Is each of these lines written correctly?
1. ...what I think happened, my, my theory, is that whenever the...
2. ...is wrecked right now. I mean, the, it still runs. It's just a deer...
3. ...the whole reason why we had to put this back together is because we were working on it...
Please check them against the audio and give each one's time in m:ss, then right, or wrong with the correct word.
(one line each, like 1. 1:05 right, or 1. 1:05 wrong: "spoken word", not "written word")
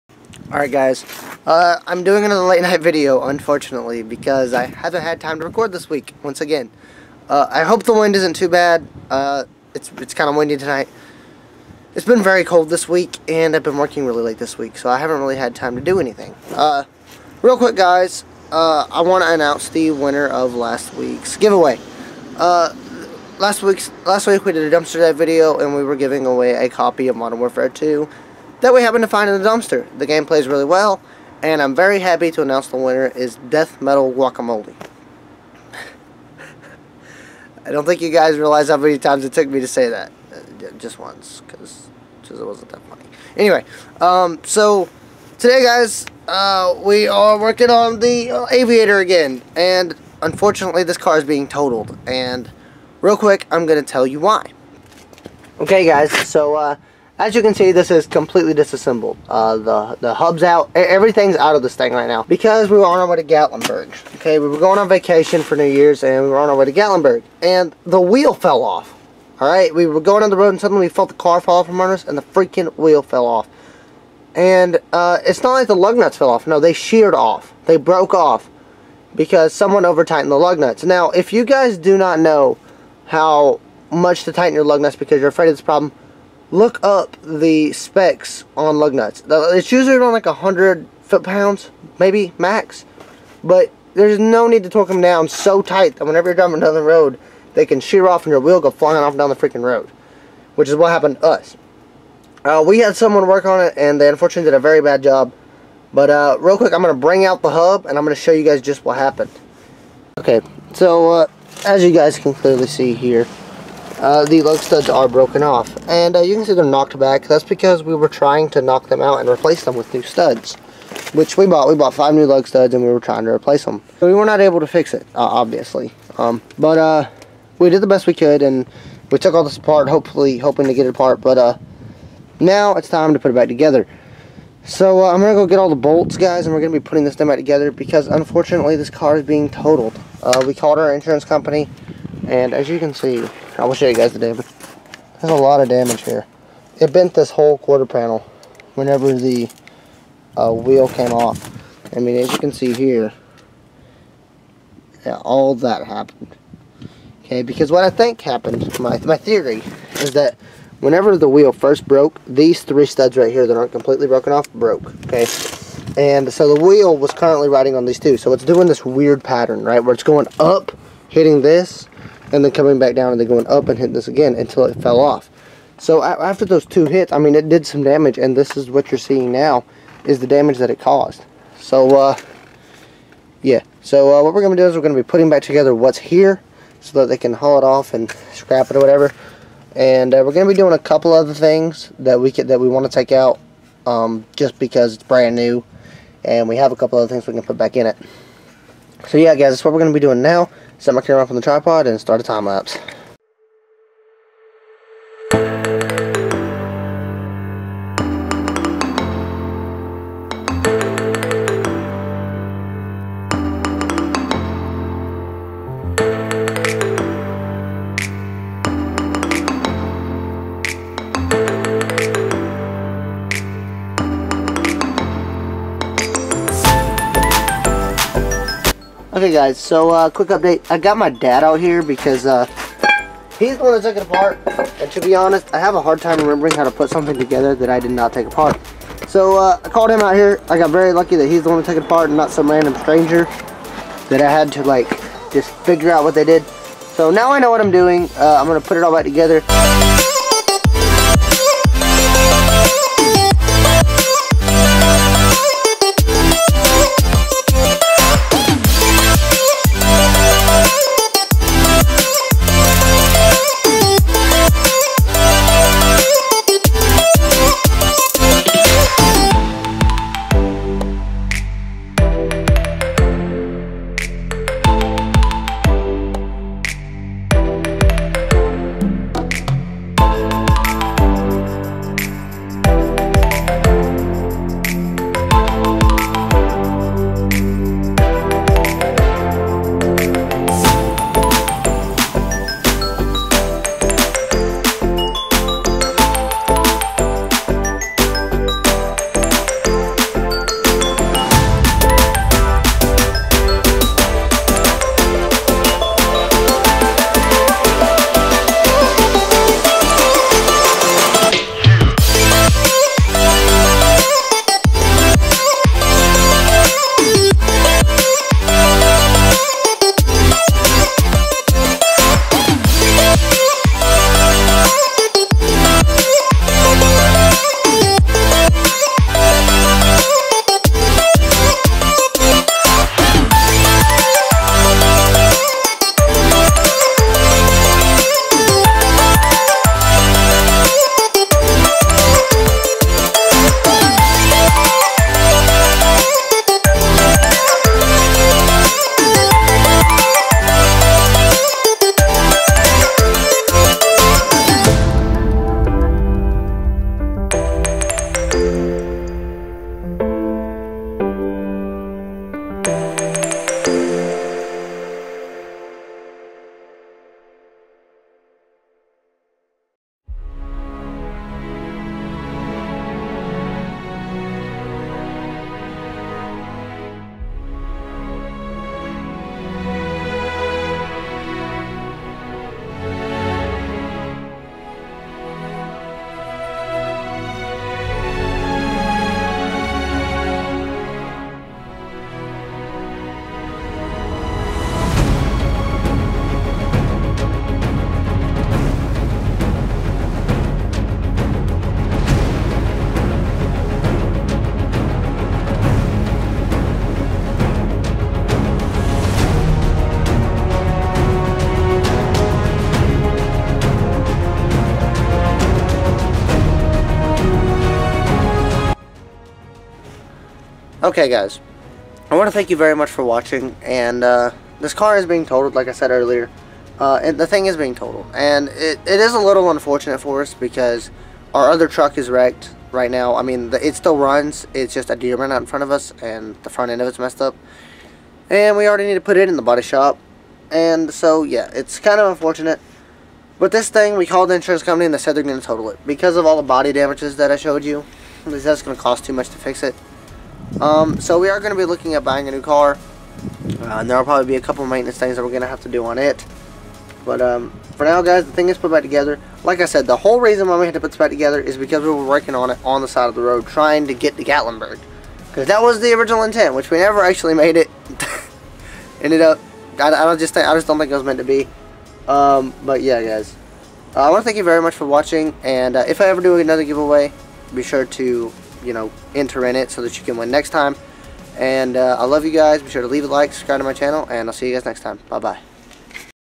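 1. 2:37 right
2. 7:11 right
3. 7:39 right.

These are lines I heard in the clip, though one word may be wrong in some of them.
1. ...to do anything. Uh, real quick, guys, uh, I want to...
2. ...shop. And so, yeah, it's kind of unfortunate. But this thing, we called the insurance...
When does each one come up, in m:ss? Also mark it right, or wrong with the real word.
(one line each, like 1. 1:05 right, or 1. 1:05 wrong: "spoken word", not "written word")
1. 0:15 right
2. 7:19 right.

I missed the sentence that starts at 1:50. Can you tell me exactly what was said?
Okay, so uh, as you guys can clearly see here, uh, the lug studs are broken off.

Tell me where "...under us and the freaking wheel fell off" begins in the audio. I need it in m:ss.
1:11.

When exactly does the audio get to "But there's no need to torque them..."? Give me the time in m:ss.
1:33.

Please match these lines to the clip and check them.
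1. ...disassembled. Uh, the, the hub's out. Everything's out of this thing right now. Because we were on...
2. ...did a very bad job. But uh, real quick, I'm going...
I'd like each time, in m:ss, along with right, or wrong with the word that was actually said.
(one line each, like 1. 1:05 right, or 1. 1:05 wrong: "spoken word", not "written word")
1. 0:58 right
2. 1:44 right.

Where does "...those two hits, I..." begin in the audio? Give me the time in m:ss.
2:56.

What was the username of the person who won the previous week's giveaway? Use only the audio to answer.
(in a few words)
Death Metal Guacamole.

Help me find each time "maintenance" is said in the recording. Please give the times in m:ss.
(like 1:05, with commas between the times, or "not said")
7:34.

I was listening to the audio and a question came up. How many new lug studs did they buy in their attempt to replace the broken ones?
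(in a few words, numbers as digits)
5.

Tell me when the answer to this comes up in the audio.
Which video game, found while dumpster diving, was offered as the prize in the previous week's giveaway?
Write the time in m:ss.
0:27.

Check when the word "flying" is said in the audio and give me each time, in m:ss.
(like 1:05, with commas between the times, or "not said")
1:38.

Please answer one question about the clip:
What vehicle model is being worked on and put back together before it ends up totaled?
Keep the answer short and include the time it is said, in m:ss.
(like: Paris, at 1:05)
Aviator, at 0:48.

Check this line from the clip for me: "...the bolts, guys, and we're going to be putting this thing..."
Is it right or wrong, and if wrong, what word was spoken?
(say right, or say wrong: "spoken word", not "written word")
right.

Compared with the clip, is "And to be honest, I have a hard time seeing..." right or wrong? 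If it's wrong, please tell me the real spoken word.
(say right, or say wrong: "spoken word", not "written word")
wrong: "remembering", not "seeing".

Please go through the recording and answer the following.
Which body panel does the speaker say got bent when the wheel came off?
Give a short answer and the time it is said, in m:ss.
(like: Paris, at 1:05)
quarter panel, at 2:27.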